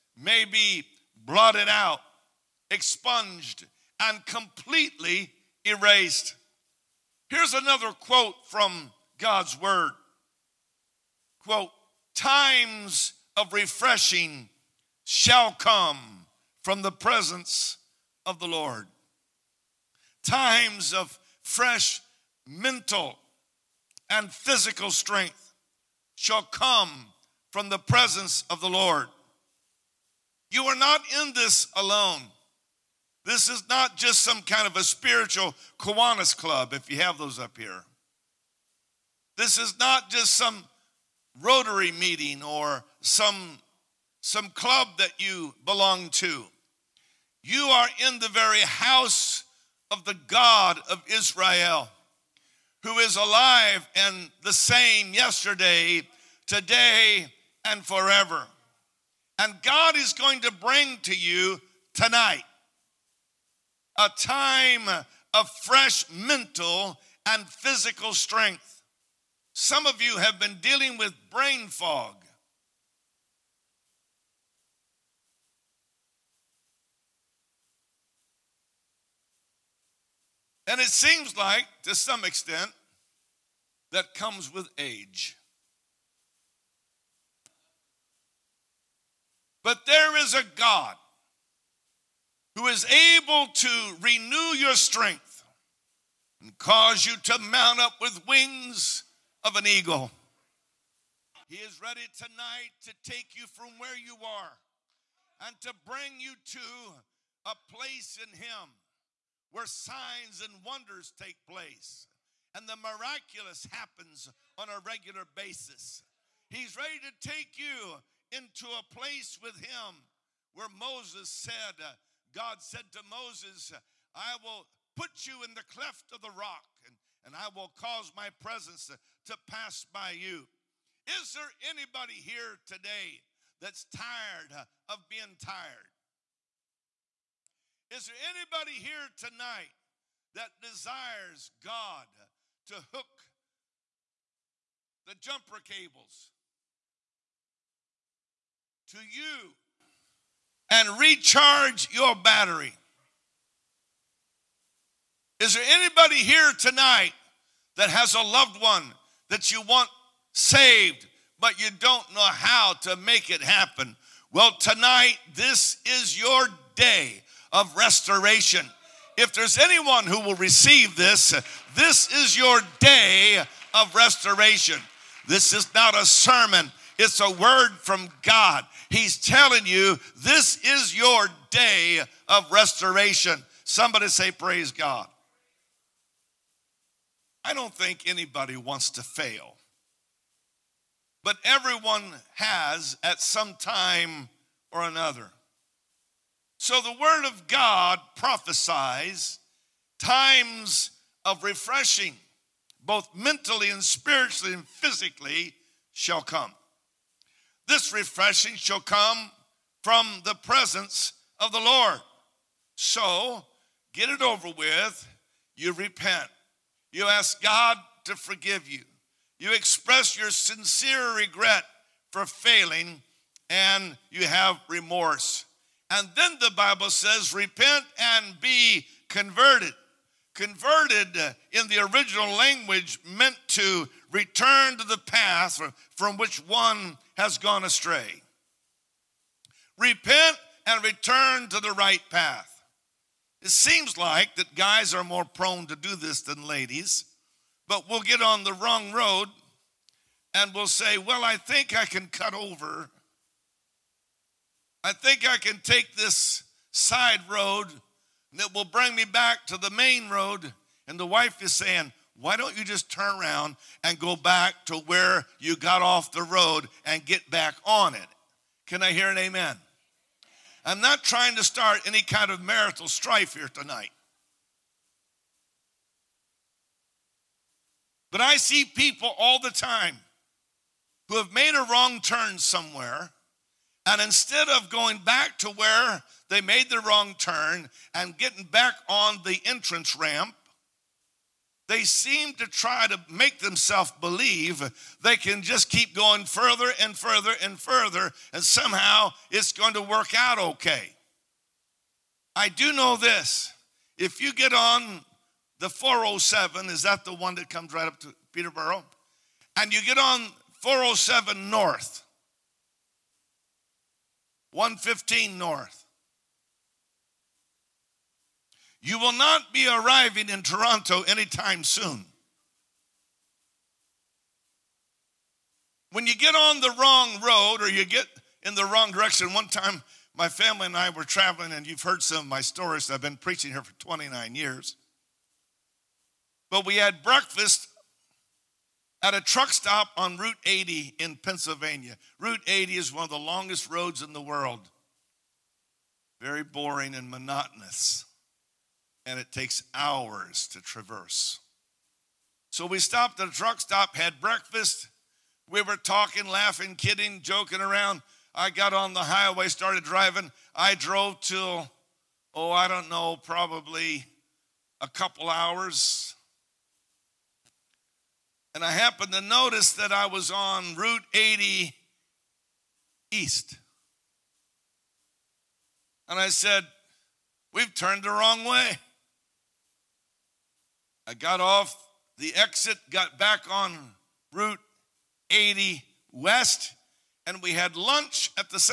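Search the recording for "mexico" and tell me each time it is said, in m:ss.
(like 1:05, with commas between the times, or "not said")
not said.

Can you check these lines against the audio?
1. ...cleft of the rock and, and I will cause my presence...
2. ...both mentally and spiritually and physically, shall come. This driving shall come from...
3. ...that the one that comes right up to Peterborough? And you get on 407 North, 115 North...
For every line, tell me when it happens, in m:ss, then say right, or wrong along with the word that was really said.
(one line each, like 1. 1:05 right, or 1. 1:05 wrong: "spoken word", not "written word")
1. 2:05 right
2. 3:22 wrong: "refreshing", not "driving"
3. 5:06 right.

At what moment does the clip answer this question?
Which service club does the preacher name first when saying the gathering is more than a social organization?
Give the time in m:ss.
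0:35.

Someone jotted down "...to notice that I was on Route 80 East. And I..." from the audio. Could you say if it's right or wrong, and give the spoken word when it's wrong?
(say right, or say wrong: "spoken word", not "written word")
right.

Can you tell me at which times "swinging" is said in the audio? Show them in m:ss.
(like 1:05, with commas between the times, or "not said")
not said.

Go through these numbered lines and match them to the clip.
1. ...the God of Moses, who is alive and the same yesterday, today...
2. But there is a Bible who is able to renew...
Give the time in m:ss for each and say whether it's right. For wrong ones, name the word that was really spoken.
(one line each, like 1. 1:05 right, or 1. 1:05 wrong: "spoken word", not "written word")
1. 0:50 wrong: "Israel", not "Moses"
2. 1:29 wrong: "God", not "Bible".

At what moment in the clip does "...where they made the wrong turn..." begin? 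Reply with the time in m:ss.
4:45.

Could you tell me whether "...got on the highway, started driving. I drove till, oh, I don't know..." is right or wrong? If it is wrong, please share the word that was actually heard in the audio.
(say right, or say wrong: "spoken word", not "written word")
right.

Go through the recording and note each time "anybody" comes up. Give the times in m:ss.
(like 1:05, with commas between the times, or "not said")
2:11, 2:18, 2:35, 3:08.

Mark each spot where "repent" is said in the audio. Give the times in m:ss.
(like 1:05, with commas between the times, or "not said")
3:35, 3:47, 3:59.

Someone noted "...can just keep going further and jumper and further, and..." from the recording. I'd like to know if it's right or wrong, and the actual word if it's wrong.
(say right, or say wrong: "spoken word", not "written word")
wrong: "further", not "jumper".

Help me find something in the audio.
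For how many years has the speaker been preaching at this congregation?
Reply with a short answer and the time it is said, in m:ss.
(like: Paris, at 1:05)
29 years, at 5:33.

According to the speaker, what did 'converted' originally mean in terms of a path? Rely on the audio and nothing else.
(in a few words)
return to the path.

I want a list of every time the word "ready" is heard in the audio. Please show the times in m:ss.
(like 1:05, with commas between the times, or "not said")
1:41, 1:56.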